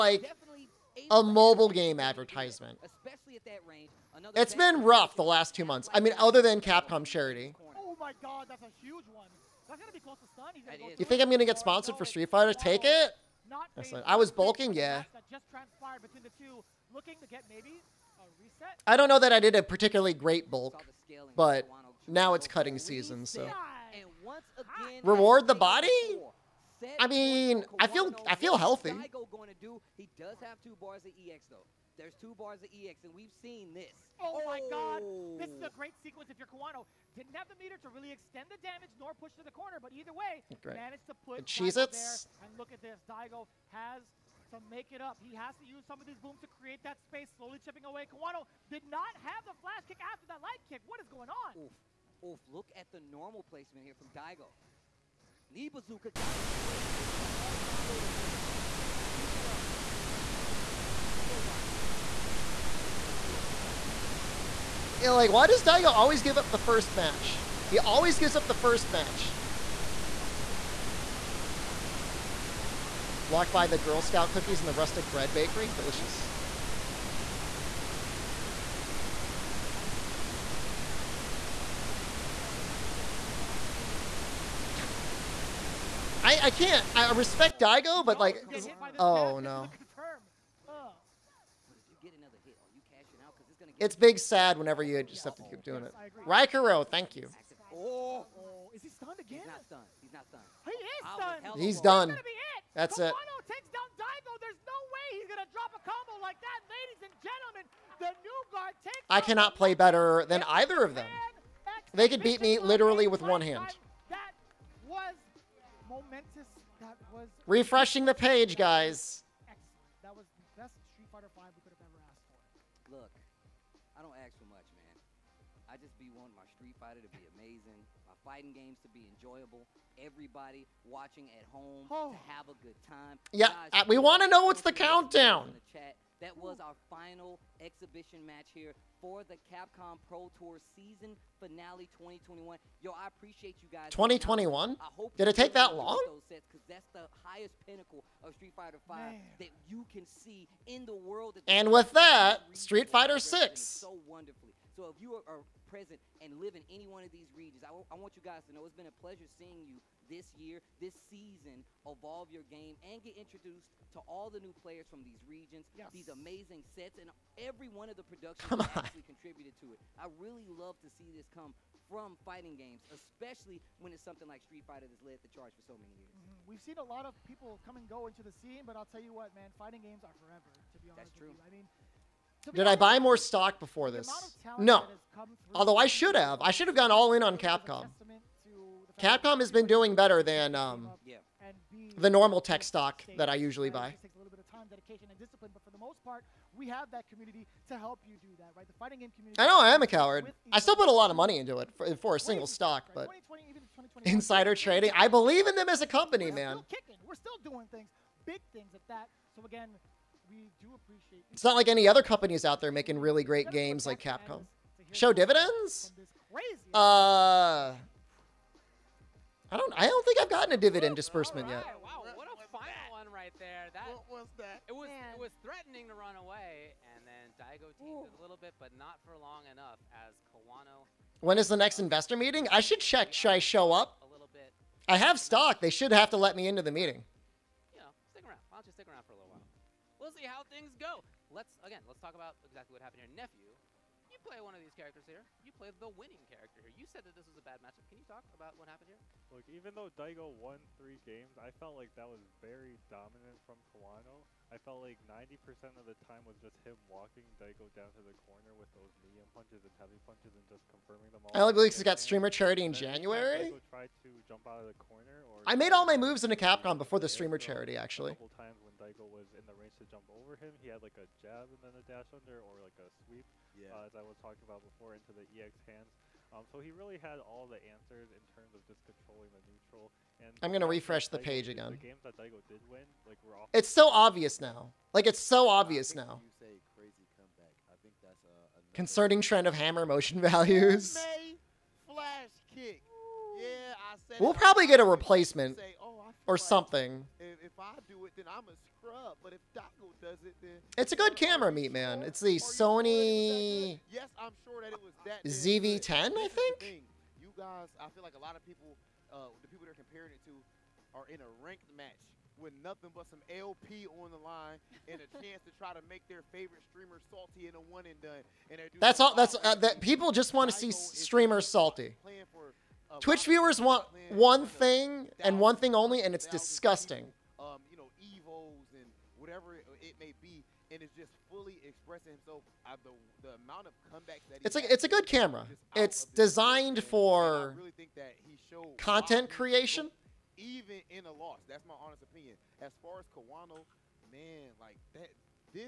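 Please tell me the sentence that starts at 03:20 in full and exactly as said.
I still put a lot of money into it for, for a single stock, but insider trading.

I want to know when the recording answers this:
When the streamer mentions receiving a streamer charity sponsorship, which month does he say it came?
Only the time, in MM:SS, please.
04:22.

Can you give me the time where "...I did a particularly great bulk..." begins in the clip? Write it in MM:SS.
00:19.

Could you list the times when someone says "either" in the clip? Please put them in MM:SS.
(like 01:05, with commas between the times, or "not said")
00:39, 01:50.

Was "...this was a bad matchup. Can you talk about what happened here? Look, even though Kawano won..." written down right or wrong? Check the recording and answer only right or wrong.
wrong.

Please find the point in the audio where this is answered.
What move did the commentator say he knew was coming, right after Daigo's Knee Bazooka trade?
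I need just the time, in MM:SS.
01:01.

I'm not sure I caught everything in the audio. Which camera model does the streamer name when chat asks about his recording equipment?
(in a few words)
ZV10.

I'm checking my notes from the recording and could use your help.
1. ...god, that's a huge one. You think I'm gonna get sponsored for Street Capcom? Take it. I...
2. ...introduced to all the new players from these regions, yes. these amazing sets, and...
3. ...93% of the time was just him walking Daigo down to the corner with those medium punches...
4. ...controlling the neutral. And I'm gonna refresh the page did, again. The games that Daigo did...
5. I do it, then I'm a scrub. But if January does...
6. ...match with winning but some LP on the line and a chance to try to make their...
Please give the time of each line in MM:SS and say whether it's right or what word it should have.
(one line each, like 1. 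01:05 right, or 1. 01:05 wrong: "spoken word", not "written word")
1. 00:08 wrong: "Fighter", not "Capcom"
2. 02:43 right
3. 04:15 wrong: "90", not "93"
4. 04:38 right
5. 04:57 wrong: "Daigo", not "January"
6. 05:11 wrong: "nothing", not "winning".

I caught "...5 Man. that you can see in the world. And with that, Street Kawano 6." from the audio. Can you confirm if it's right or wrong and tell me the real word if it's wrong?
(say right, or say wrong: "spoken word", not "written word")
wrong: "Fighter", not "Kawano".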